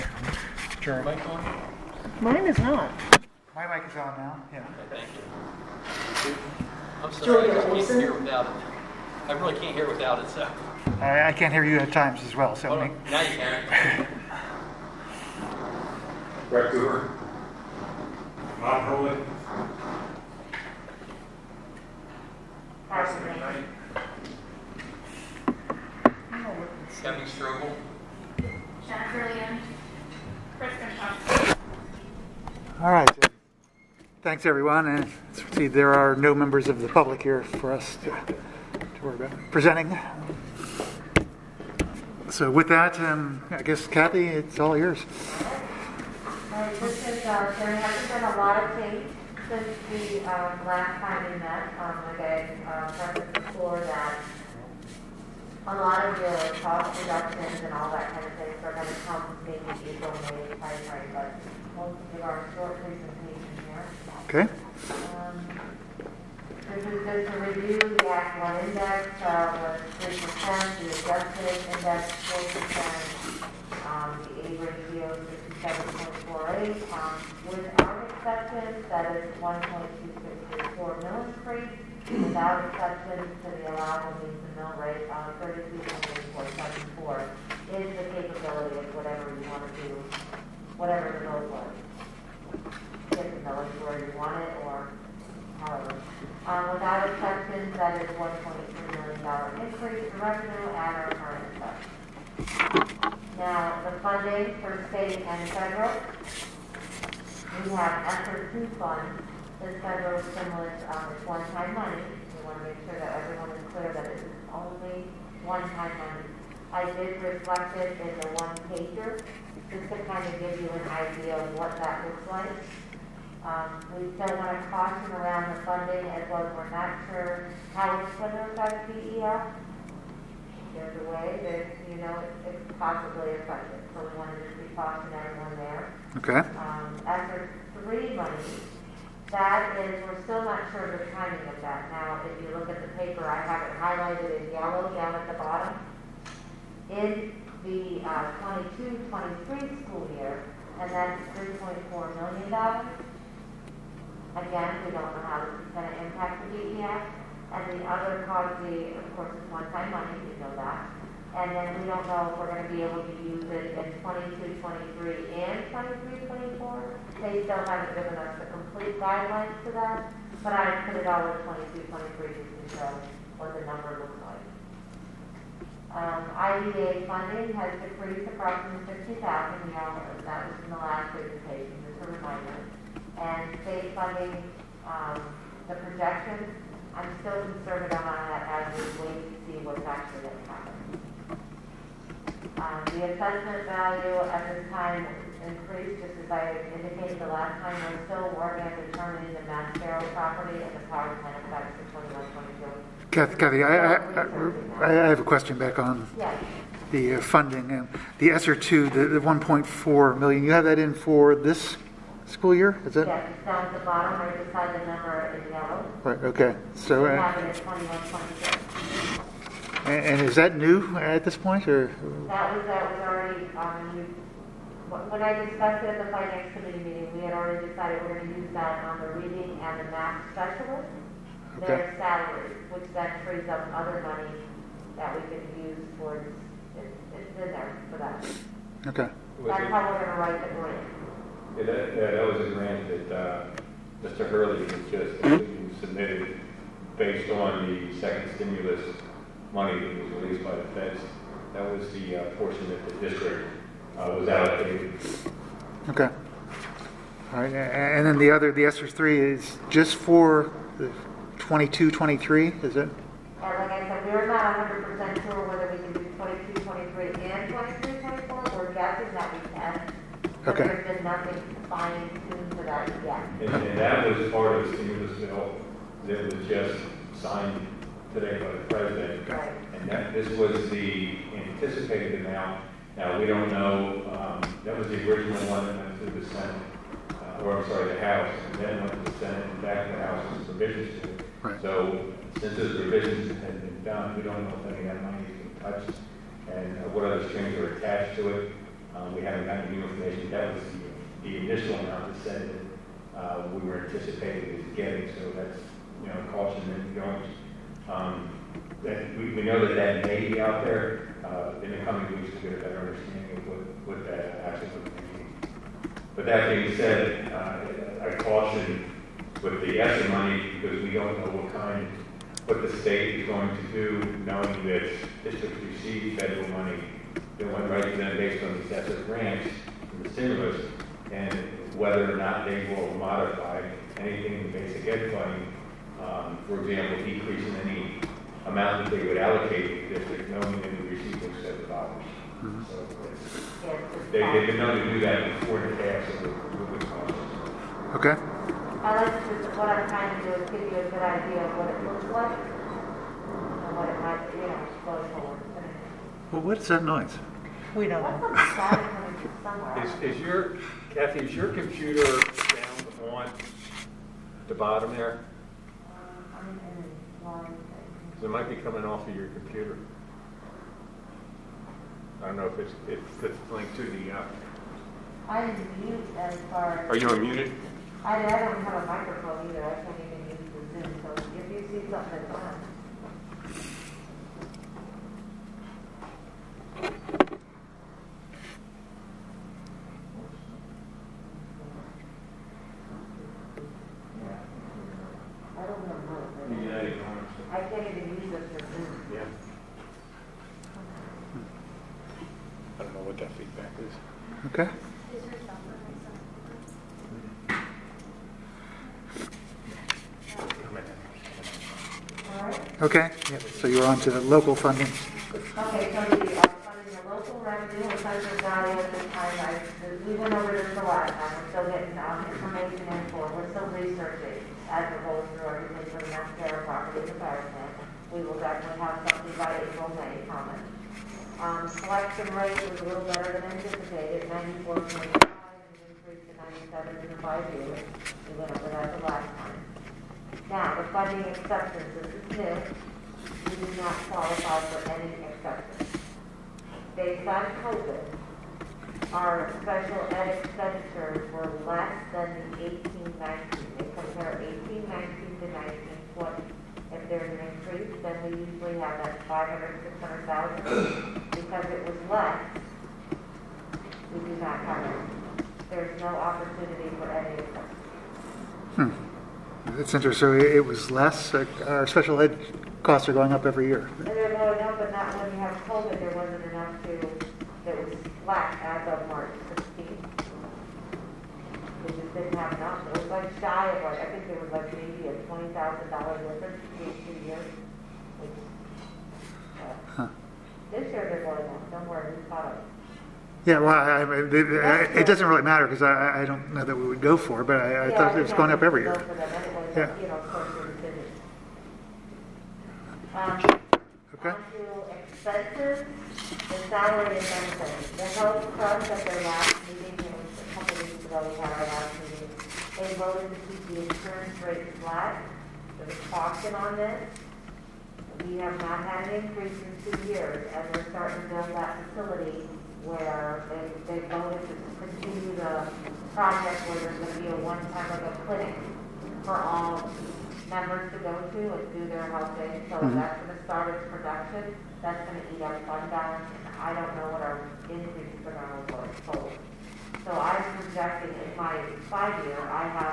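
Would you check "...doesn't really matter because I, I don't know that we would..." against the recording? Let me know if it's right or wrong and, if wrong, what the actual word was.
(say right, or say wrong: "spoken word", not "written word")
right.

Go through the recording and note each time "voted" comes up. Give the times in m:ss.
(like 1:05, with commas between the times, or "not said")
8:32, 8:44.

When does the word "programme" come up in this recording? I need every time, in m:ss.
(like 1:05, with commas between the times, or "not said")
not said.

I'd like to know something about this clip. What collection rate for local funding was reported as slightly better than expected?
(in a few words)
94.5.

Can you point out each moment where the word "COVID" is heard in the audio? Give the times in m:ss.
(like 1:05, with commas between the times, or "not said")
7:27, 7:55.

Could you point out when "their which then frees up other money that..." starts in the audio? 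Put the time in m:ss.
3:51.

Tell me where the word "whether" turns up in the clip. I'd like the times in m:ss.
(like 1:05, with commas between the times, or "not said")
4:25, 5:31.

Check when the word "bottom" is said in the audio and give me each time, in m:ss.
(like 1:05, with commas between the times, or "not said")
2:25, 3:33, 6:04.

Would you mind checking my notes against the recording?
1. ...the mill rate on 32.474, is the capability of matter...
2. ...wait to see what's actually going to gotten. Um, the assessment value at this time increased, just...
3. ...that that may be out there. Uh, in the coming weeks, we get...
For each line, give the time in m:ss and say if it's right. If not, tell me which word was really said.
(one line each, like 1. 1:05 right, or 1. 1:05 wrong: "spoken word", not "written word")
1. 1:24 wrong: "whatever", not "matter"
2. 3:09 wrong: "happen", not "gotten"
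3. 5:09 right.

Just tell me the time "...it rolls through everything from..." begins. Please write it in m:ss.
7:04.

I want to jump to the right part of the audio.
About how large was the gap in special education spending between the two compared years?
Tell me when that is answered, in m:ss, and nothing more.
8:05.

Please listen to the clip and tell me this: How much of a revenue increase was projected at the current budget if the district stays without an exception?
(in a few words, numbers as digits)
$1.3 million.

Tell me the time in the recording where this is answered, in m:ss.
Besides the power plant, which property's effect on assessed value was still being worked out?
3:19.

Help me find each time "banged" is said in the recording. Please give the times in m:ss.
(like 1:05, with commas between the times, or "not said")
not said.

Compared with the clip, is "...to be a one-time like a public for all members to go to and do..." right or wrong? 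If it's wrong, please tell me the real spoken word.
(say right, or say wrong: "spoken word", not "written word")
wrong: "clinic", not "public".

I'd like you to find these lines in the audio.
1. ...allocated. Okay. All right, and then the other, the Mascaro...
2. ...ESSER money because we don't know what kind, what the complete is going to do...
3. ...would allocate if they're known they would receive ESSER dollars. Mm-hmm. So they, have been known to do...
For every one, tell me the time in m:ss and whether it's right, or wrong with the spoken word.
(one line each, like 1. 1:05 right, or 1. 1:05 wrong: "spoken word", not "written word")
1. 4:14 wrong: "ESSER", not "Mascaro"
2. 5:19 wrong: "state", not "complete"
3. 5:39 right.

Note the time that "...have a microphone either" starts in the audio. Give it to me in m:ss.
6:18.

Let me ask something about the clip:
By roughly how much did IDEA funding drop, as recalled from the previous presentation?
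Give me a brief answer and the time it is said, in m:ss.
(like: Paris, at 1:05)
50,000, at 2:58.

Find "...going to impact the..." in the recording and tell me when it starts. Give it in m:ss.
2:35.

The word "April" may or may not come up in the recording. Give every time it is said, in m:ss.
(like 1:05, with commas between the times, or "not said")
0:59, 7:09.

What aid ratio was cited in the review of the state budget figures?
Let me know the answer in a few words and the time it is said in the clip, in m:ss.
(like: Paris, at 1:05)
67.48, at 1:15.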